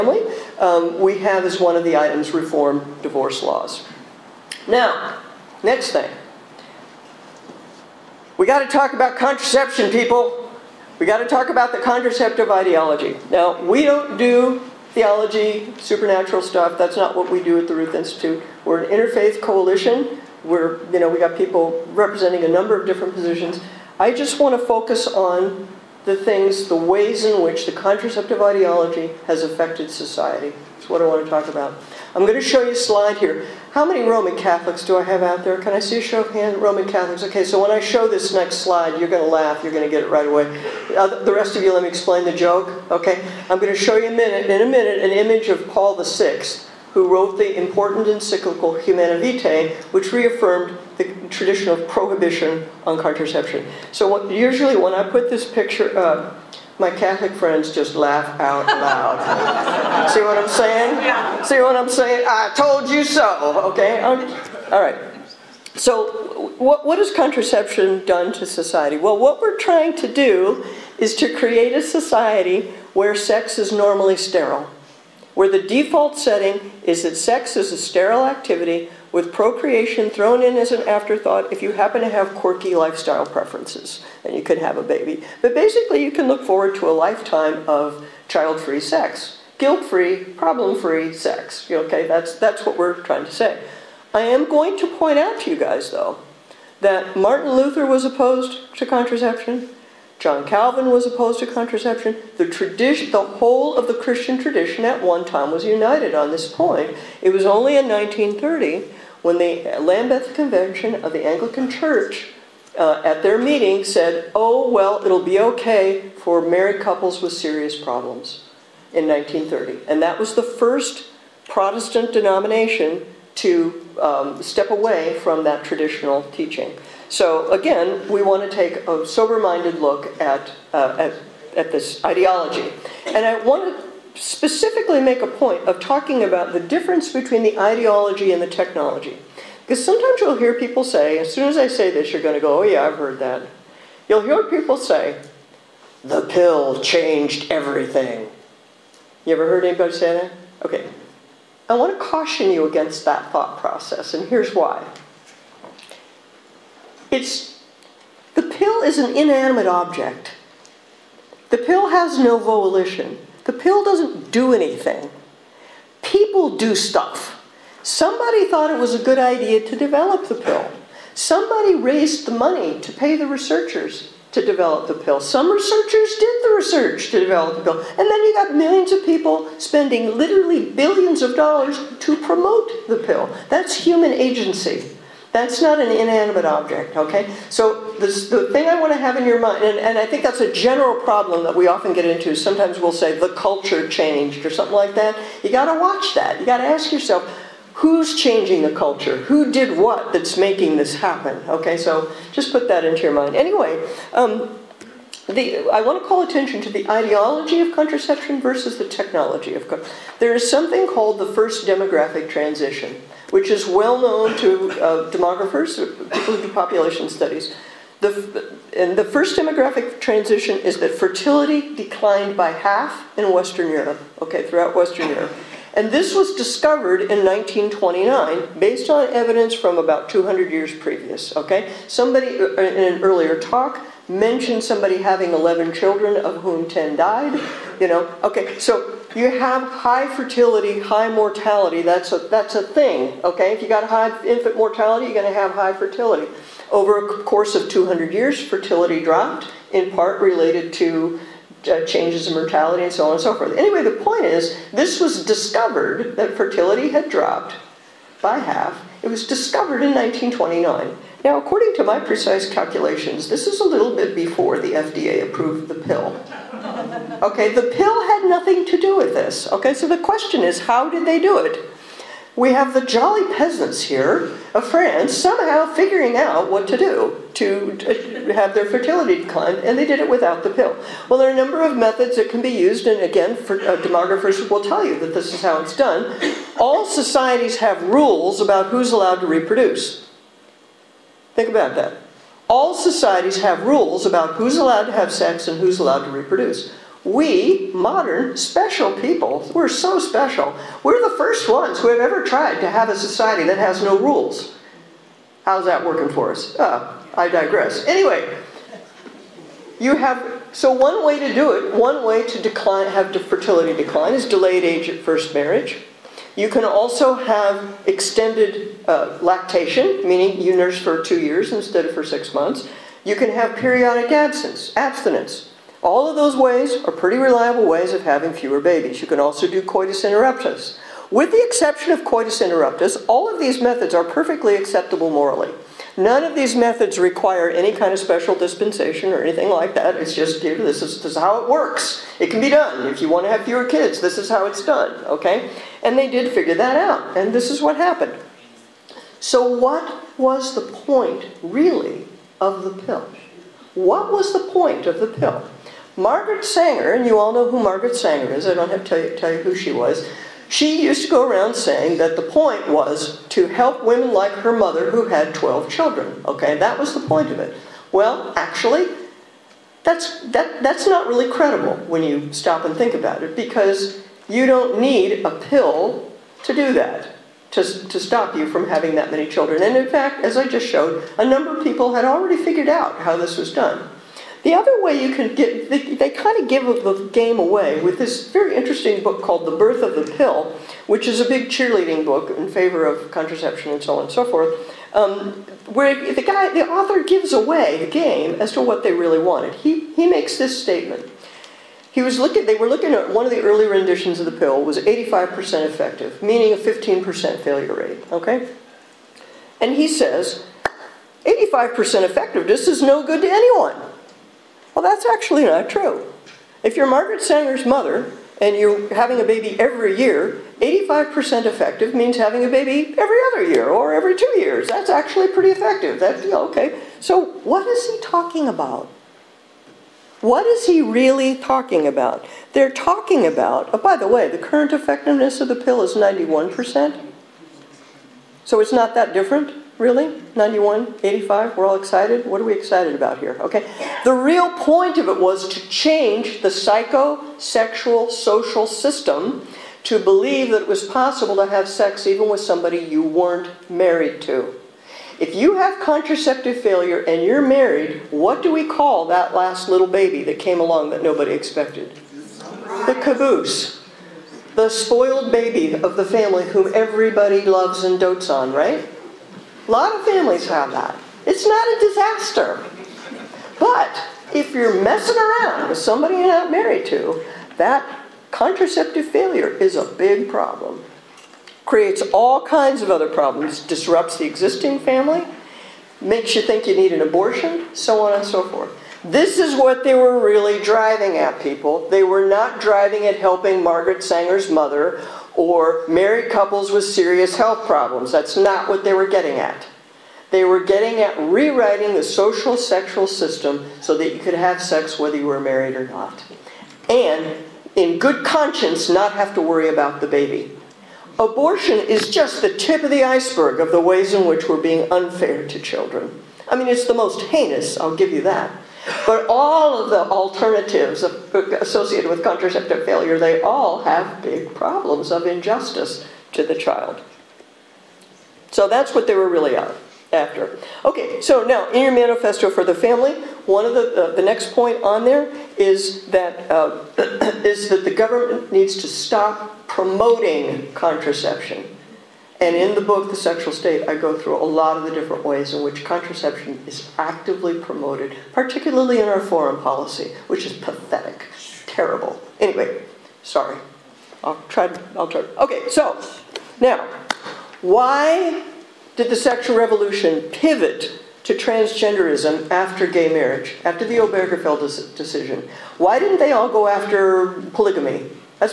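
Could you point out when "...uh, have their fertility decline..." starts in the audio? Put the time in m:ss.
4:38.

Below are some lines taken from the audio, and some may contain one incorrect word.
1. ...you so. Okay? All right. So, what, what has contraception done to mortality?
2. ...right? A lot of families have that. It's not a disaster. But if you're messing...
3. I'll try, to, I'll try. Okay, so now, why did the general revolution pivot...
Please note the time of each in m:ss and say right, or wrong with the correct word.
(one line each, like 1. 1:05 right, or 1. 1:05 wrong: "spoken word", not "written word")
1. 1:02 wrong: "society", not "mortality"
2. 7:48 right
3. 9:14 wrong: "sexual", not "general".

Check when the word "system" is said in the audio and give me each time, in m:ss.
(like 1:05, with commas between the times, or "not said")
7:28, 8:23.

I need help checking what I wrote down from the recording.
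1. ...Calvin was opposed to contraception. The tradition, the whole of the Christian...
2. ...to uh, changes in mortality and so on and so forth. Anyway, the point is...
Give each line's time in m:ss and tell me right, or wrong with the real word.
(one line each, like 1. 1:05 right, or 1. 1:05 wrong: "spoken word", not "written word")
1. 1:40 right
2. 4:10 right.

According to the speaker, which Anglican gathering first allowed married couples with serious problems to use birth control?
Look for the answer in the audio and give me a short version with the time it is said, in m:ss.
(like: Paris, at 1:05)
Lambeth Convention, at 1:49.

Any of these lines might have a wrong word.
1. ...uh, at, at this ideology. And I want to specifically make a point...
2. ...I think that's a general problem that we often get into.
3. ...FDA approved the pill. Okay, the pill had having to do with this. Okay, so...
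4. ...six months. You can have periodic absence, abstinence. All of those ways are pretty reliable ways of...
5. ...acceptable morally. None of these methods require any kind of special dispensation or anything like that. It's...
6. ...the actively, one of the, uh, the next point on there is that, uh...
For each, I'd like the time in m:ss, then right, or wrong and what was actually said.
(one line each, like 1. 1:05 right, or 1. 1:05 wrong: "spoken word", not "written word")
1. 2:10 right
2. 3:09 right
3. 4:24 wrong: "nothing", not "having"
4. 5:22 right
5. 5:34 right
6. 8:52 wrong: "family", not "actively".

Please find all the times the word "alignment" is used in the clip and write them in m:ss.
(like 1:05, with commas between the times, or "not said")
not said.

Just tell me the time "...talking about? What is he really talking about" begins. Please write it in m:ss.
7:08.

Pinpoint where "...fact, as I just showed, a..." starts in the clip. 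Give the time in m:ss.
6:19.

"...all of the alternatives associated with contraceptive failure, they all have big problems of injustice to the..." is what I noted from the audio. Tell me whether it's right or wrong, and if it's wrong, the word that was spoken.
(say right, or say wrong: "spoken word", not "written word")
right.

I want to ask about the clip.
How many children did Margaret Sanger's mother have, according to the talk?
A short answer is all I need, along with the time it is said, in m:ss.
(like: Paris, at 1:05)
12, at 6:05.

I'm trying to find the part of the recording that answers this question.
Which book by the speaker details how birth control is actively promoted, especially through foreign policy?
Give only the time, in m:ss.
9:03.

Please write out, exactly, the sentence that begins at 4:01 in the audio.
That's a, that's a thing, okay?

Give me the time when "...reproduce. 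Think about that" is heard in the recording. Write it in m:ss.
4:49.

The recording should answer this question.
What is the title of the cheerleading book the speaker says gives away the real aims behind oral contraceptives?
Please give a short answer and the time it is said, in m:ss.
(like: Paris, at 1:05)
The Birth of the Pill, at 6:29.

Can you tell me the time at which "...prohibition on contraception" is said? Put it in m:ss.
0:51.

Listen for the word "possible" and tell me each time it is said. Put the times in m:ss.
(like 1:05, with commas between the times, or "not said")
7:30.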